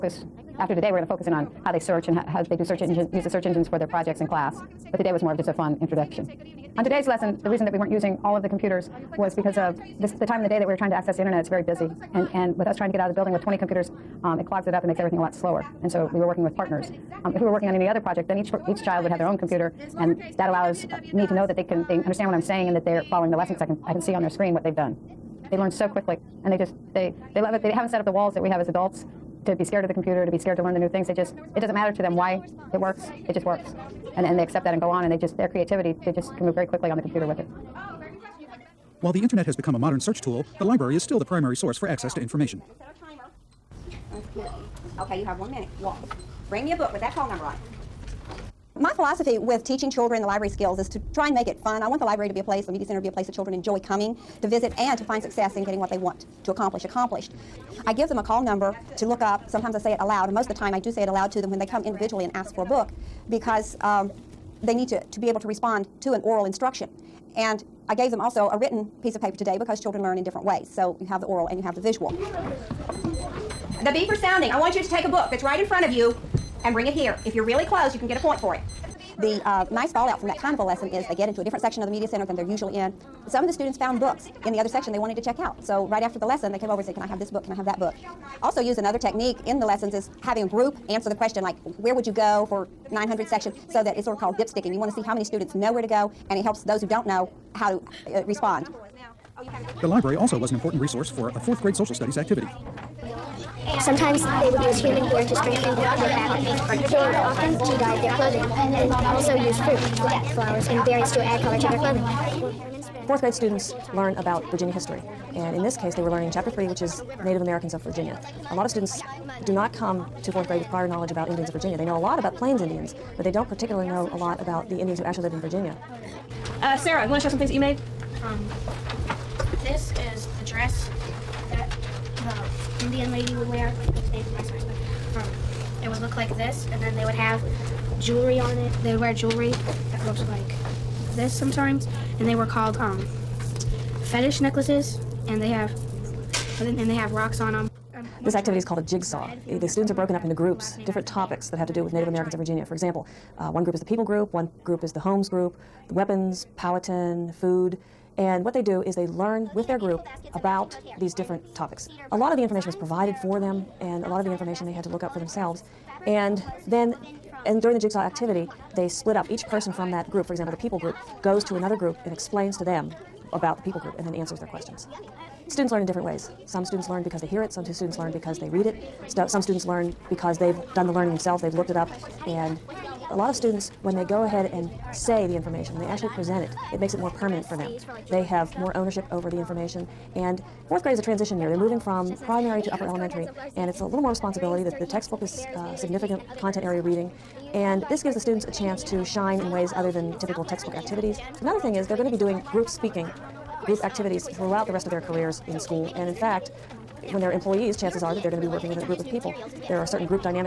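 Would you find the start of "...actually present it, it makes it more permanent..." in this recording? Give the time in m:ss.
3:05.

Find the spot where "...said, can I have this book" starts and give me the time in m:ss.
1:26.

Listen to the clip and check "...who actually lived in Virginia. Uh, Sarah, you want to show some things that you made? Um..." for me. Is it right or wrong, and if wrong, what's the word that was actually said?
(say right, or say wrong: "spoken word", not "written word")
right.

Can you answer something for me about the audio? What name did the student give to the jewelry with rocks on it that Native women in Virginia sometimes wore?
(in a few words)
fetish necklaces.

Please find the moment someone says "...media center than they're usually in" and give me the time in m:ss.
1:21.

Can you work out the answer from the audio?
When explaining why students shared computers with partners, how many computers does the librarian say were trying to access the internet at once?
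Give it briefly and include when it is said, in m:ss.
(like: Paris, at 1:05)
20, at 0:13.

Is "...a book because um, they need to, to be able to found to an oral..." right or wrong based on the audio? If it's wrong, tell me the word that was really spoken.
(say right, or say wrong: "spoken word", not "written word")
wrong: "respond", not "found".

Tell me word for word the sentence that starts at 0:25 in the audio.
They learn so quickly, and they just they they love it.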